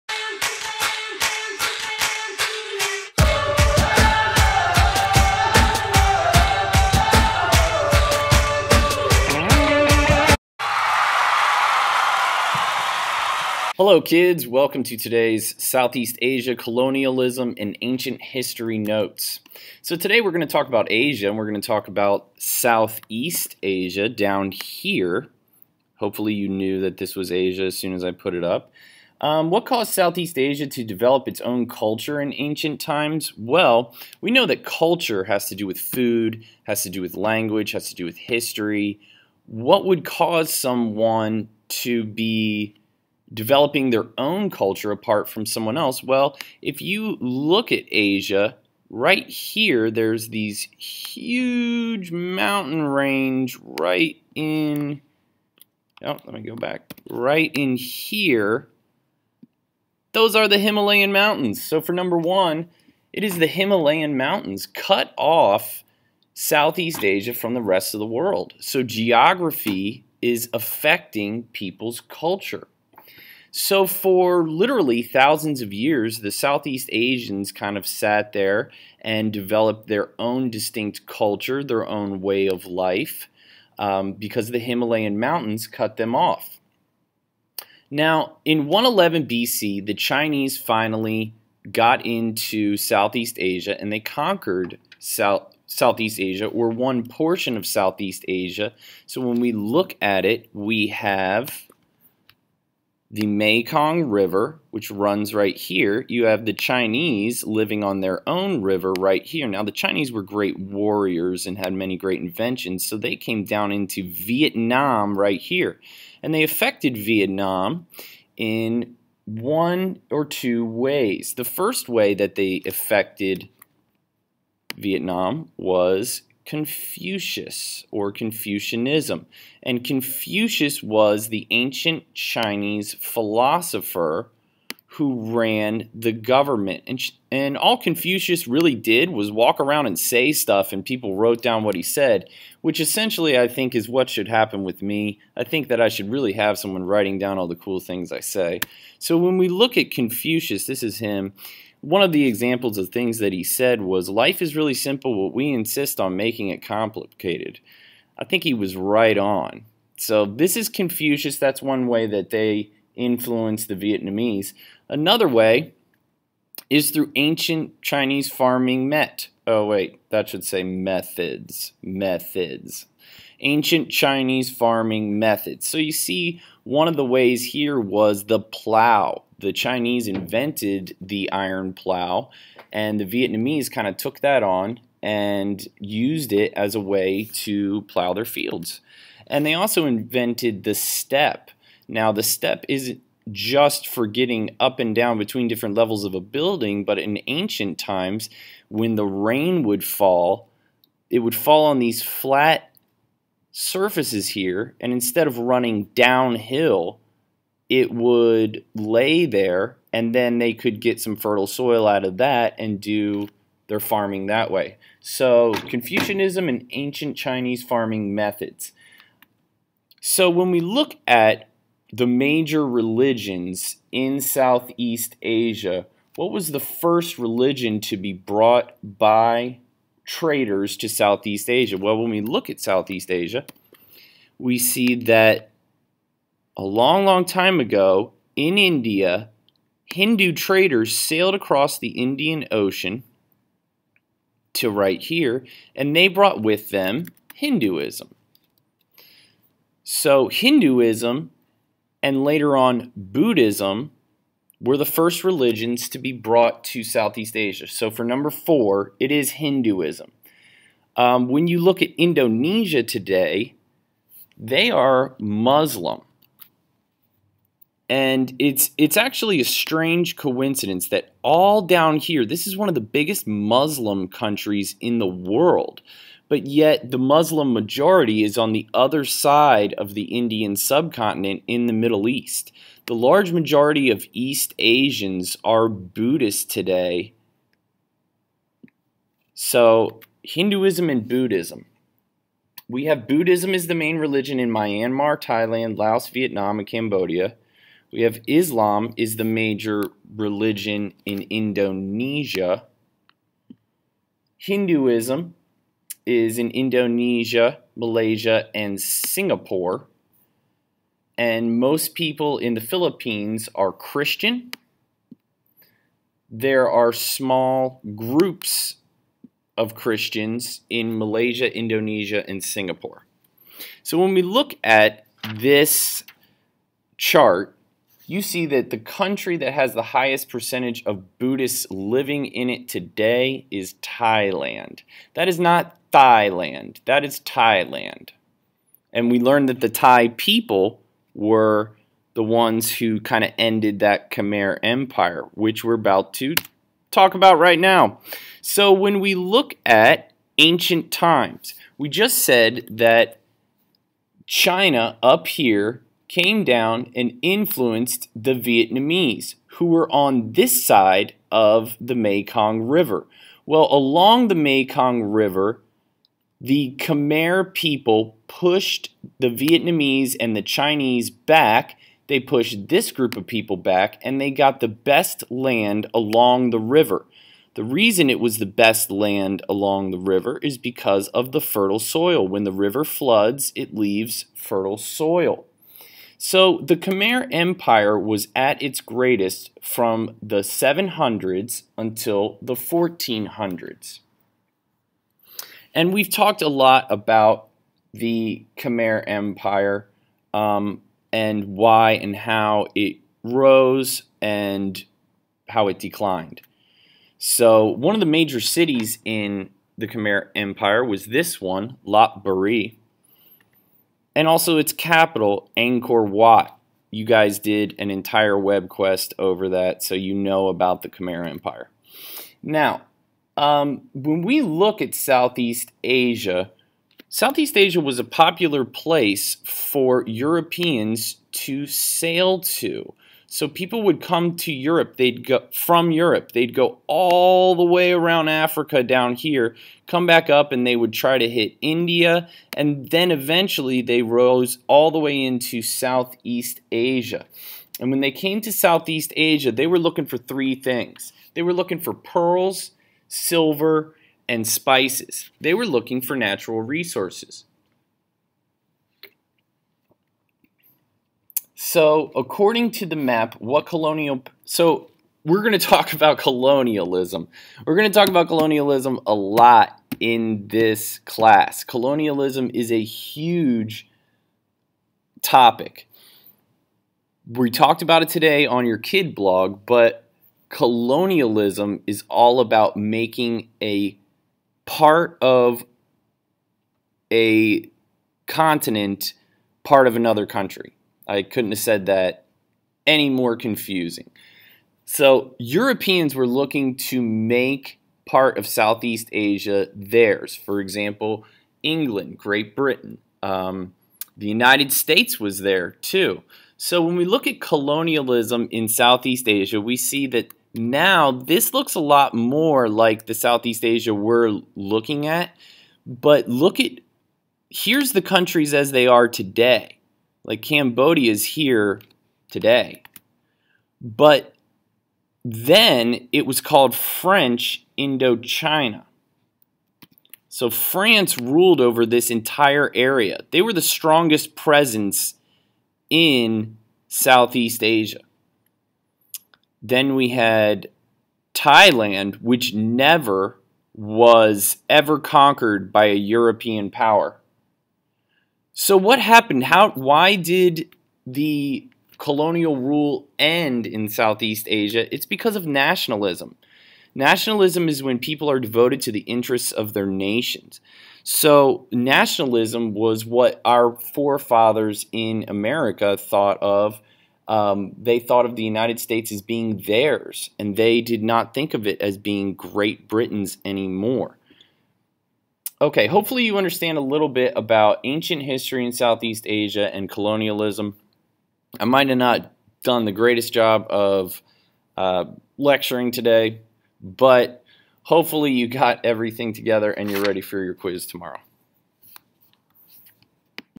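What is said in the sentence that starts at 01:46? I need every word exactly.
You have the Chinese living on their own river right here.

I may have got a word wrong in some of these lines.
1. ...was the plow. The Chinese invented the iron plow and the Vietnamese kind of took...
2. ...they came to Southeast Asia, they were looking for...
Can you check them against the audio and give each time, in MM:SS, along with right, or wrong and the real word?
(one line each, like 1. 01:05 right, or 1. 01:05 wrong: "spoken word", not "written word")
1. 02:57 right
2. 07:28 right.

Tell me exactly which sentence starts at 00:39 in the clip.
What would cause someone to be developing their own culture apart from someone else?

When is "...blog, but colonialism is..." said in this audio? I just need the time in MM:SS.
07:59.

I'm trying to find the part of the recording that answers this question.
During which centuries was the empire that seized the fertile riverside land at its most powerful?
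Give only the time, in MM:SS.
06:30.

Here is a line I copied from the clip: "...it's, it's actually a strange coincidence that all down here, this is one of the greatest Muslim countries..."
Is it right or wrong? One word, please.
wrong.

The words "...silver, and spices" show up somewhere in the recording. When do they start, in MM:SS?
07:33.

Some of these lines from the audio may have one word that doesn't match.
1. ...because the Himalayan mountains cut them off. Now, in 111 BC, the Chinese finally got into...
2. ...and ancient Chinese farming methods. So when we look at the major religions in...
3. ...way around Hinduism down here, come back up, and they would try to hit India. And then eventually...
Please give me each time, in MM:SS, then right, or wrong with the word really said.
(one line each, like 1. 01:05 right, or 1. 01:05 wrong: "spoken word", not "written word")
1. 01:24 right
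2. 03:36 right
3. 07:17 wrong: "Africa", not "Hinduism".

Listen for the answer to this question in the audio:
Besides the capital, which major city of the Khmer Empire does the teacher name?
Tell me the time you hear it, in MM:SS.
06:51.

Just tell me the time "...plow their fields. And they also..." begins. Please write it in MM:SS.
03:07.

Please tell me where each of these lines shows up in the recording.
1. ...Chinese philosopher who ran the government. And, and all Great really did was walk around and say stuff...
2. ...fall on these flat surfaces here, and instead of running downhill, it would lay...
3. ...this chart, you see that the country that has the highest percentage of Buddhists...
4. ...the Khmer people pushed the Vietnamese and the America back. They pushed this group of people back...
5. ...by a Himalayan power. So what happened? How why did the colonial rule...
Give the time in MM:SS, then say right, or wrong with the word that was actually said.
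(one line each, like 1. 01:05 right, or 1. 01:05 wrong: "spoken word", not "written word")
1. 02:12 wrong: "Confucius", not "Great"
2. 03:21 right
3. 05:25 right
4. 06:06 wrong: "Chinese", not "America"
5. 09:05 wrong: "European", not "Himalayan".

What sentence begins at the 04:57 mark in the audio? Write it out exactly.
We have Islam is the major religion in Indonesia.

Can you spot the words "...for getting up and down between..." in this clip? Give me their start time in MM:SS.
03:13.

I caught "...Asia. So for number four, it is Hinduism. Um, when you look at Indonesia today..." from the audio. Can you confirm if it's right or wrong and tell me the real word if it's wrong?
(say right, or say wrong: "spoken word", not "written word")
right.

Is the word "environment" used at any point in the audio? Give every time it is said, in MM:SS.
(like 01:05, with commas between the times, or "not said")
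not said.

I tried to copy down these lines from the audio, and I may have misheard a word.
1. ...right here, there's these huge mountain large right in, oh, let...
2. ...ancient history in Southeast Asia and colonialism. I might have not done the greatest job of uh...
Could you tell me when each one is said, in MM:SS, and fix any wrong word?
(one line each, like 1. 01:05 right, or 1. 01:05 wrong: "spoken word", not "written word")
1. 00:48 wrong: "range", not "large"
2. 09:37 right.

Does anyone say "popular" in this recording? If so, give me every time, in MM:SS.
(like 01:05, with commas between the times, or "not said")
07:08.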